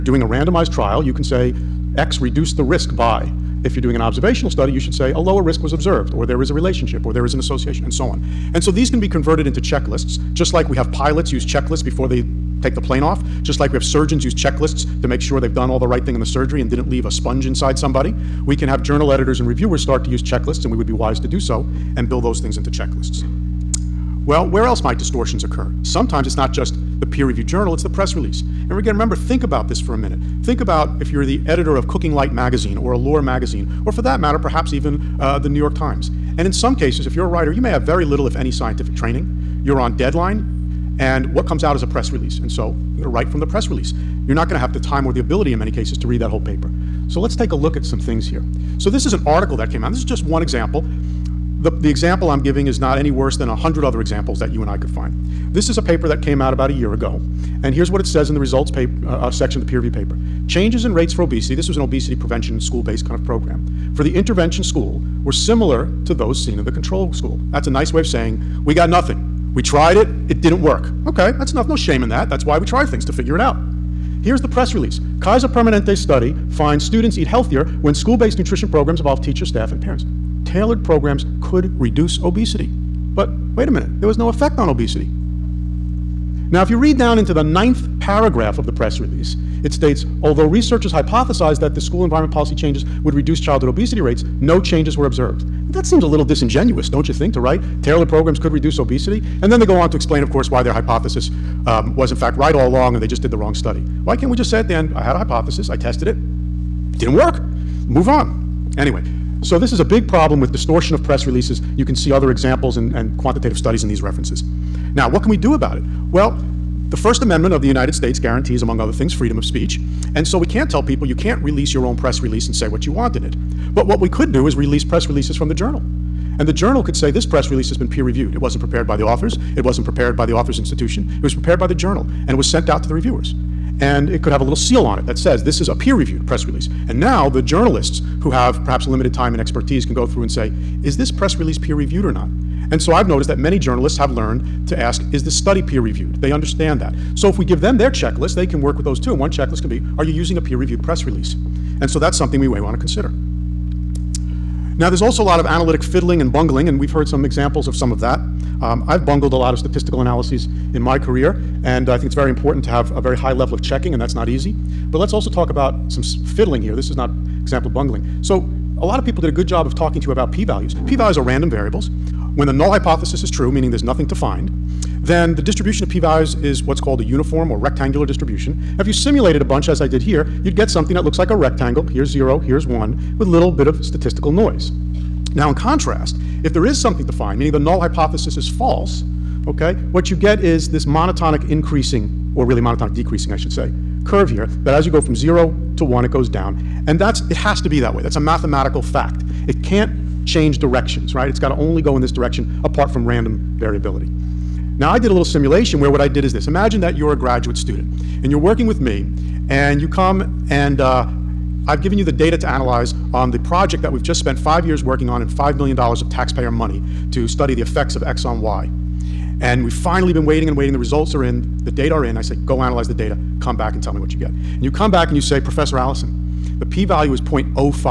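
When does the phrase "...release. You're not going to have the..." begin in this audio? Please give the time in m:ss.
0:43.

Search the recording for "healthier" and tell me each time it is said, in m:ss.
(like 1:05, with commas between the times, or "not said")
1:17.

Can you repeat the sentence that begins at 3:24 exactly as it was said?
Now, I did a little simulation where what I did is this.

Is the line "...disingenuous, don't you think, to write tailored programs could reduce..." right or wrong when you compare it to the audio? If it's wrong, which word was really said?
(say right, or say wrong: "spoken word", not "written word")
right.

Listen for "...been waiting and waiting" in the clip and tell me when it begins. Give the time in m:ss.
3:40.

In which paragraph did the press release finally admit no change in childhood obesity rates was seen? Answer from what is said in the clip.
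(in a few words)
ninth.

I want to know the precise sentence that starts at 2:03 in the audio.
But what we could do is release press releases from the journal.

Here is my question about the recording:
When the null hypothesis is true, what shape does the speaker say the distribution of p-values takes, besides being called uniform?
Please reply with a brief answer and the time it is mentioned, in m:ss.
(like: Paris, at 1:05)
rectangular, at 2:57.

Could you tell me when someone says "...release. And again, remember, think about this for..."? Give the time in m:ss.
0:28.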